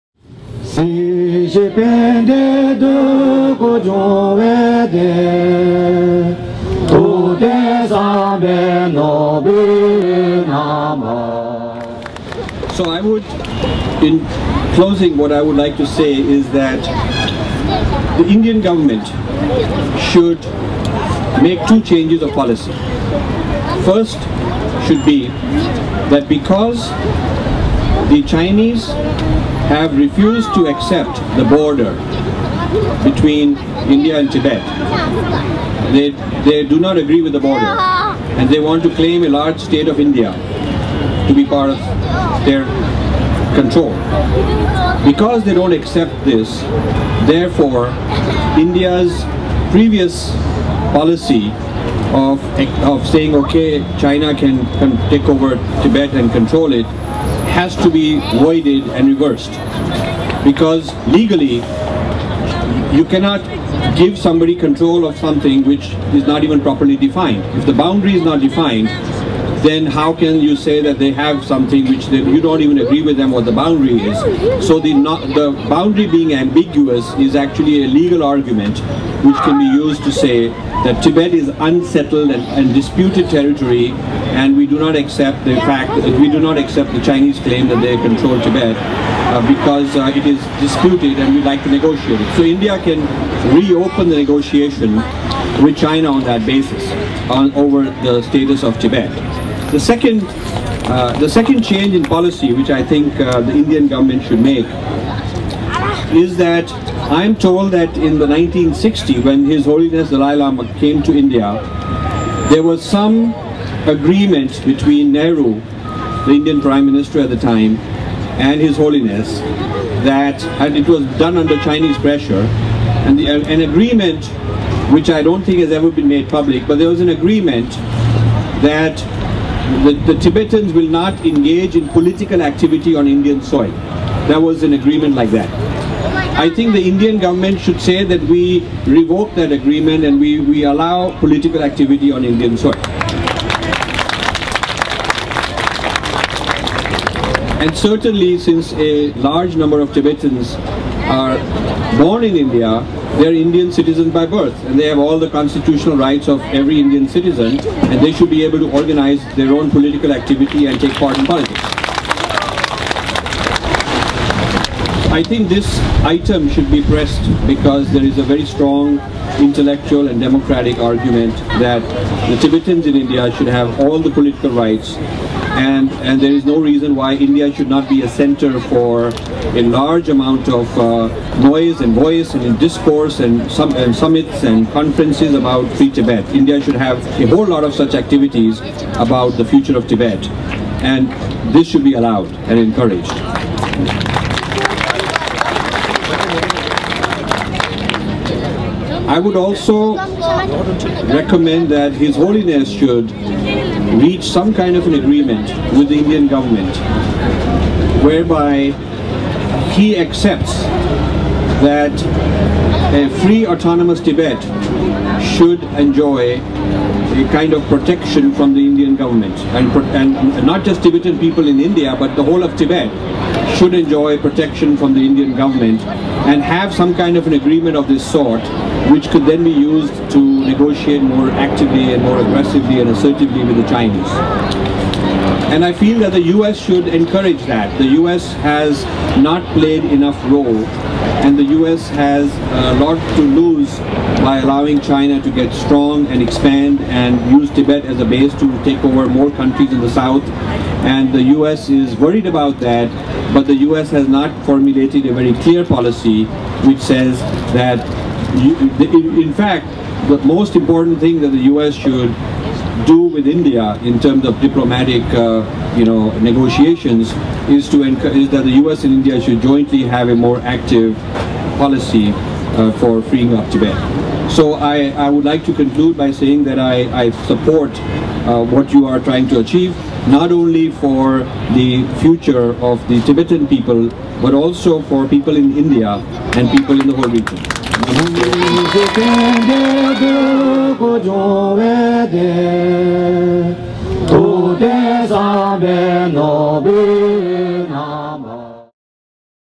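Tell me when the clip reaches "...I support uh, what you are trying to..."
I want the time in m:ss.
4:37.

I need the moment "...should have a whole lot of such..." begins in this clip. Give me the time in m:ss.
3:06.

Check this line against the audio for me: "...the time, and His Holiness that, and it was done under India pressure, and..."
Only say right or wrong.
wrong.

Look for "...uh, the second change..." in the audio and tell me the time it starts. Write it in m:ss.
1:40.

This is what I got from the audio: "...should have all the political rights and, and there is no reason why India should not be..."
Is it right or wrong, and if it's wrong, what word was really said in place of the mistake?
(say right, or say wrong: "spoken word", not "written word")
right.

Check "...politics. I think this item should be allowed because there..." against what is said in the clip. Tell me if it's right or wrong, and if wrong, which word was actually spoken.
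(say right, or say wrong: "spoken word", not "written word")
wrong: "pressed", not "allowed".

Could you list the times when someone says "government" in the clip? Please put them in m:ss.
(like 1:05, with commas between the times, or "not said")
0:18, 1:43, 2:17, 3:26, 3:38, 3:45.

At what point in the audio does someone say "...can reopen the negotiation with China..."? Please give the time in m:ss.
1:32.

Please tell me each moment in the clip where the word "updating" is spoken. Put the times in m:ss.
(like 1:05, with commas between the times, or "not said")
not said.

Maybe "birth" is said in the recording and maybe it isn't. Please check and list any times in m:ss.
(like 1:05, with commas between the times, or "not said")
2:34.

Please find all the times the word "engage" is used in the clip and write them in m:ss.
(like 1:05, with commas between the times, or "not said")
2:11.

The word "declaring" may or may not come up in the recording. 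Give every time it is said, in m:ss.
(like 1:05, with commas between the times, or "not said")
not said.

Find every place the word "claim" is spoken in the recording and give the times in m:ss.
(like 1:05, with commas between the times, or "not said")
0:38, 1:27.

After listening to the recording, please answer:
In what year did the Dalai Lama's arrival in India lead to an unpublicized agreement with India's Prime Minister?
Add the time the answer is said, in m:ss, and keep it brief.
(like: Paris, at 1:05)
1960, at 1:48.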